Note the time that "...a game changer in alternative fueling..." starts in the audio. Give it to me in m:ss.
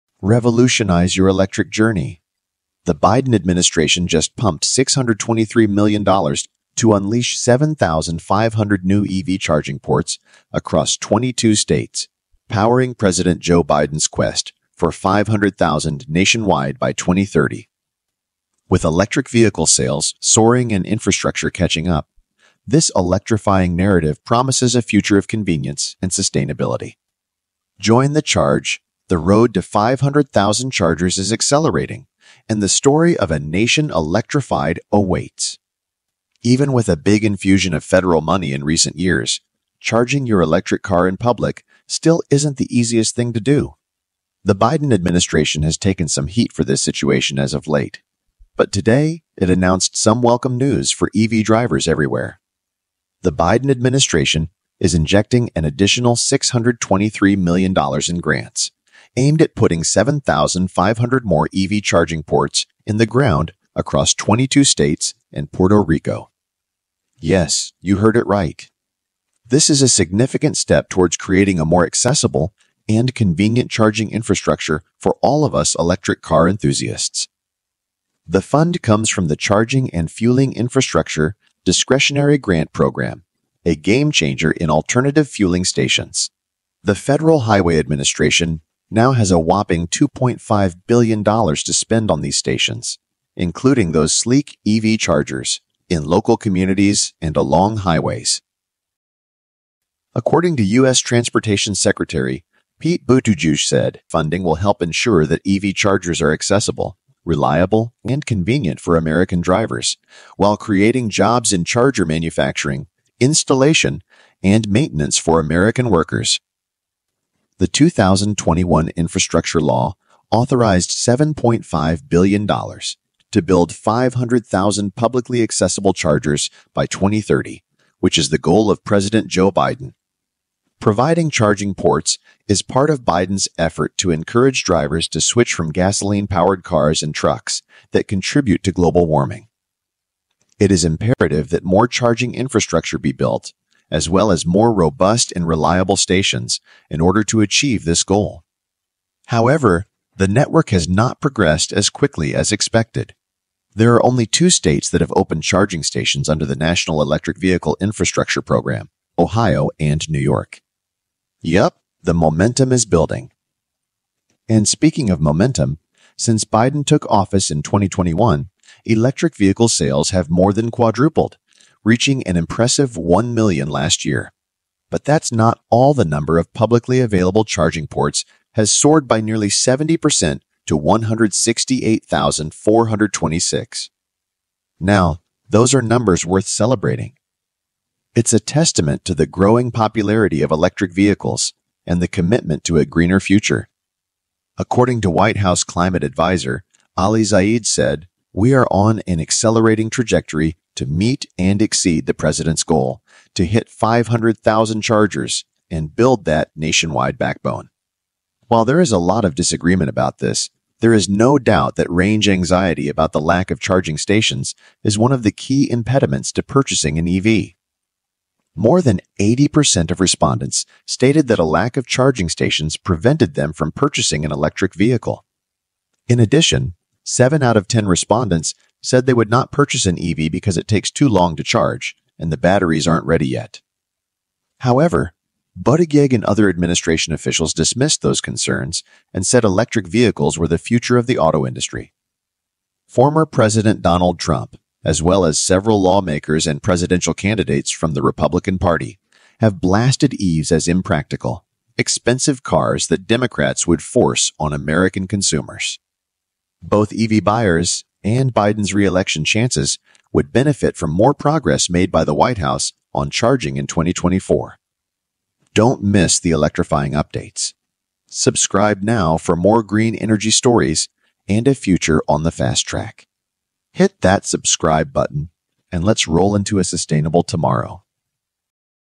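1:23.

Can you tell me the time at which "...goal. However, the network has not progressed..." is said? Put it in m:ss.
2:28.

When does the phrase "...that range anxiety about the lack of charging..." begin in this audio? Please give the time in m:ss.
3:31.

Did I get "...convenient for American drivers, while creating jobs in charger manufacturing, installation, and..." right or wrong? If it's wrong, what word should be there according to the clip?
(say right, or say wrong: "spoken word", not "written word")
right.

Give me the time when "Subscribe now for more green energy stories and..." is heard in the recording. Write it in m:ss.
4:28.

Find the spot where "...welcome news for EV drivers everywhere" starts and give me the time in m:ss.
0:50.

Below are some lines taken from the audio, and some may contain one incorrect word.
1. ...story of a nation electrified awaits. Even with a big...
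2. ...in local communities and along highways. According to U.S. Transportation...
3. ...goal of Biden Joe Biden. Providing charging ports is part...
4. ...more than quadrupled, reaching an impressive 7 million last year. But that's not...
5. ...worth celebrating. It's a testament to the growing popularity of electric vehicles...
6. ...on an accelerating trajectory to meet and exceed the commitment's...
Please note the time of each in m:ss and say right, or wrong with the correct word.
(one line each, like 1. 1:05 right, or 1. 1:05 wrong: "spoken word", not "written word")
1. 0:32 right
2. 1:35 right
3. 2:08 wrong: "President", not "Biden"
4. 2:50 wrong: "1", not "7"
5. 3:06 right
6. 3:18 wrong: "president", not "commitment".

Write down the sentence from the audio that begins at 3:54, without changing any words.
However, Buttigieg and other administration officials dismissed those concerns and said electric vehicles were the future of the auto industry.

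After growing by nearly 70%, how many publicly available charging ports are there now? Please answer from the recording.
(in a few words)
168,426.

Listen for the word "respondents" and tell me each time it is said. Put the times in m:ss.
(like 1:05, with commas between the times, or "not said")
3:40, 3:47.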